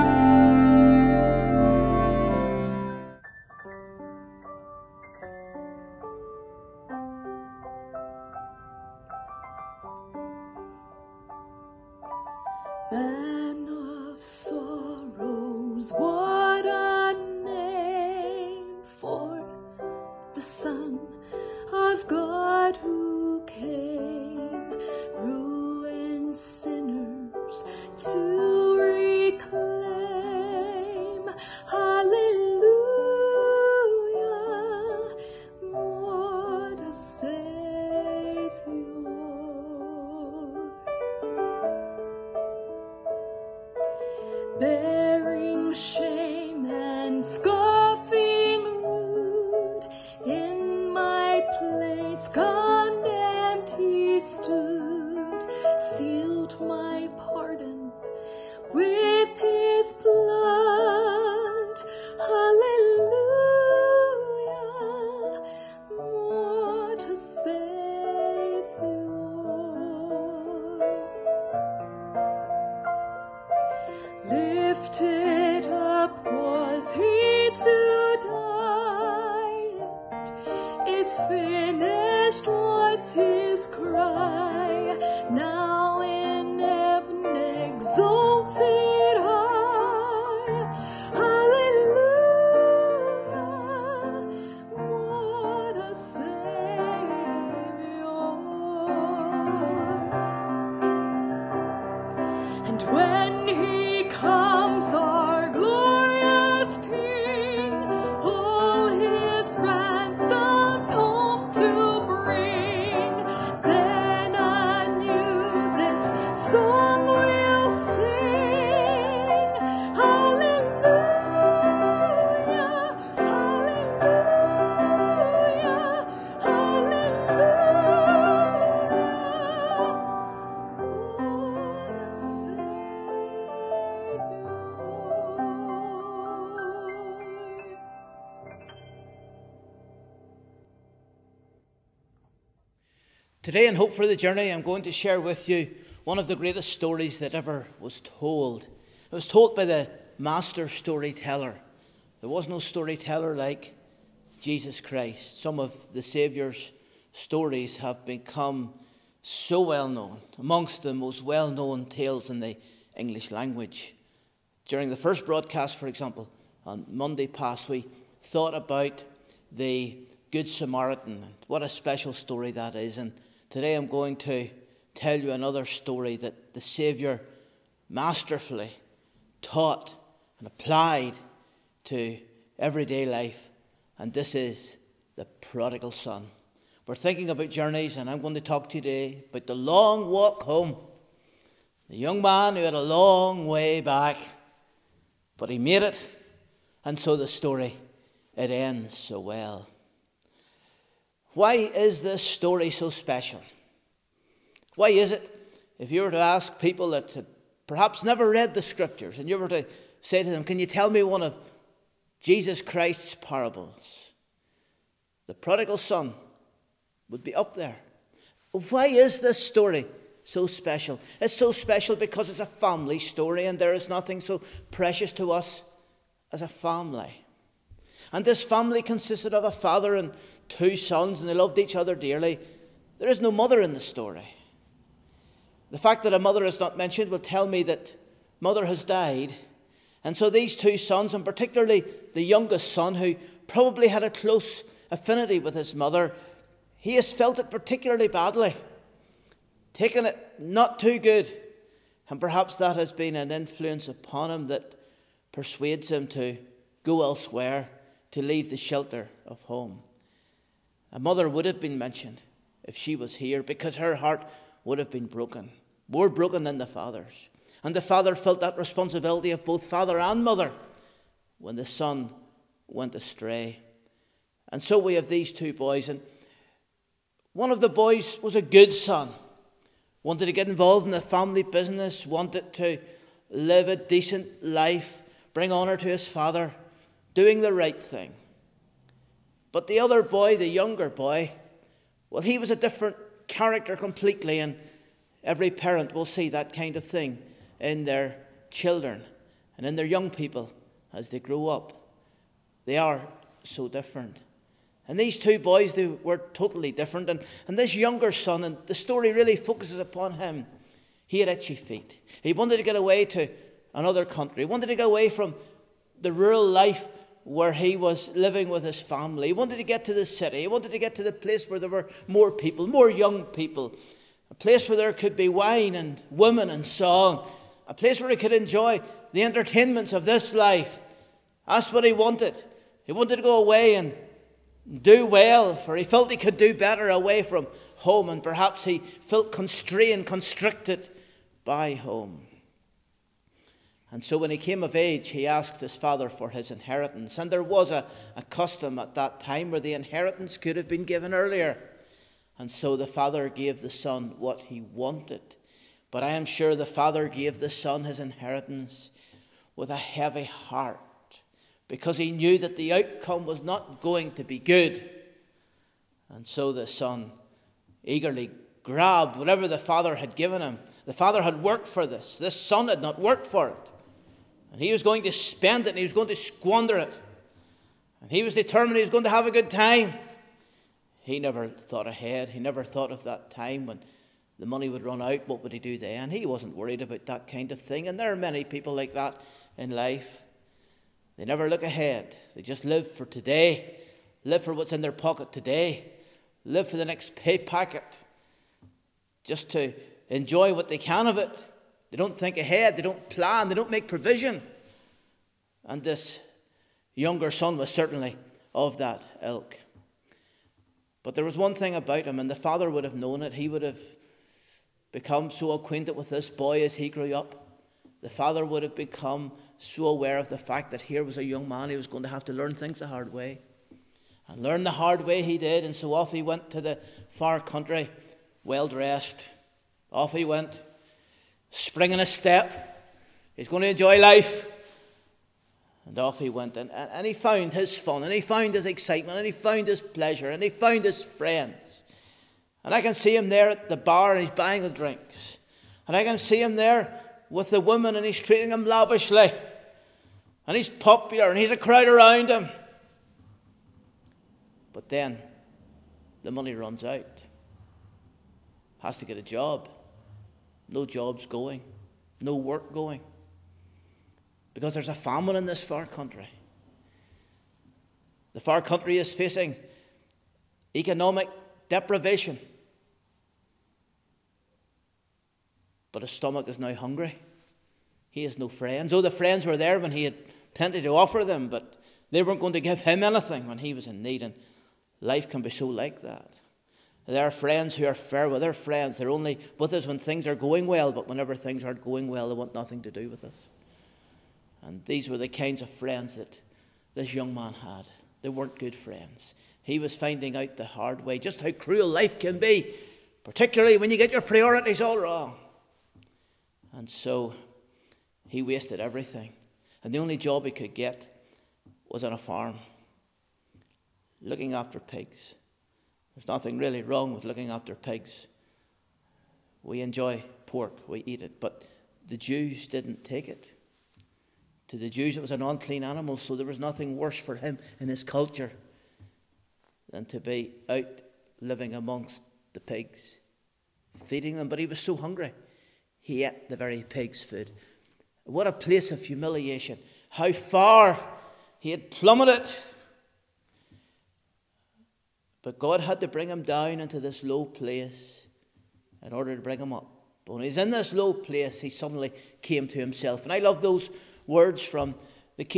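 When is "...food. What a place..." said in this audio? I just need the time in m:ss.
8:57.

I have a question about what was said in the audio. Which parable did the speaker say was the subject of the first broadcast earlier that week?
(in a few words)
The Good Samaritan.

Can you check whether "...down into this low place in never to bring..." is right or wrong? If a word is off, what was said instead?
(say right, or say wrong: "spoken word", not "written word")
wrong: "order", not "never".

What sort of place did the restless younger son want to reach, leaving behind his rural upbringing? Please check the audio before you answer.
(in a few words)
The city.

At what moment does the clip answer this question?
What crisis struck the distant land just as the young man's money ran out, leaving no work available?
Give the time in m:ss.
7:44.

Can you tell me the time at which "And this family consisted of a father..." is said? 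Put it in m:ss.
3:48.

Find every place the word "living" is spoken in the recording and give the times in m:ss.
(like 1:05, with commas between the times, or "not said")
5:18, 8:51.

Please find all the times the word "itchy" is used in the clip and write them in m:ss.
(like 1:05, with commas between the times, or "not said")
5:11.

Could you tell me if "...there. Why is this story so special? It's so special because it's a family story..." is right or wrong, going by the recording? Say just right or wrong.
right.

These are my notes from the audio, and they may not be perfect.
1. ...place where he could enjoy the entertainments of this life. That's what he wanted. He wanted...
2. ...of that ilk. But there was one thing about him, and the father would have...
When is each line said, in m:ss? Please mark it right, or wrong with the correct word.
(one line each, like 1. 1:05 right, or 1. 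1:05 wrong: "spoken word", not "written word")
1. 5:27 right
2. 6:48 right.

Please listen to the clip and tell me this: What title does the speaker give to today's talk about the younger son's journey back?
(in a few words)
The long walk home.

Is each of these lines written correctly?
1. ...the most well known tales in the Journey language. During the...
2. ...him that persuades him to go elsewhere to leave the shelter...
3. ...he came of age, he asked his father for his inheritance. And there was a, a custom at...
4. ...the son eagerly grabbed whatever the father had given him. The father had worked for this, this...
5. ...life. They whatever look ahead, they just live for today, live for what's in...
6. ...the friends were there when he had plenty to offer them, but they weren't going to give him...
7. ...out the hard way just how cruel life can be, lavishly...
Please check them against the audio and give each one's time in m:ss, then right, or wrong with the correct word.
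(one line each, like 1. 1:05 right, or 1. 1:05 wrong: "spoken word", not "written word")
1. 2:40 wrong: "English", not "Journey"
2. 4:14 right
3. 5:44 right
4. 6:06 right
5. 6:29 wrong: "never", not "whatever"
6. 7:59 right
7. 8:20 wrong: "particularly", not "lavishly".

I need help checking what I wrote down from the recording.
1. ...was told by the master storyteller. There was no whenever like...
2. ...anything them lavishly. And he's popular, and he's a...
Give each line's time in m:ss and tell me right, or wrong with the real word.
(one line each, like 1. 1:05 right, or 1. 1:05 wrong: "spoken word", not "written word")
1. 2:29 wrong: "storyteller", not "whenever"
2. 7:28 wrong: "treating", not "anything".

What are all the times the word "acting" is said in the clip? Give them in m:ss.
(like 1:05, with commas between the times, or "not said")
not said.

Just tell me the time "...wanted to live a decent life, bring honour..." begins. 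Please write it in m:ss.
4:42.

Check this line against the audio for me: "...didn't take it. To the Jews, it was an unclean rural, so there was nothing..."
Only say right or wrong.
wrong.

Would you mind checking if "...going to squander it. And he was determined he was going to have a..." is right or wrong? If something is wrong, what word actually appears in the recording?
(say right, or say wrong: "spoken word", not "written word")
right.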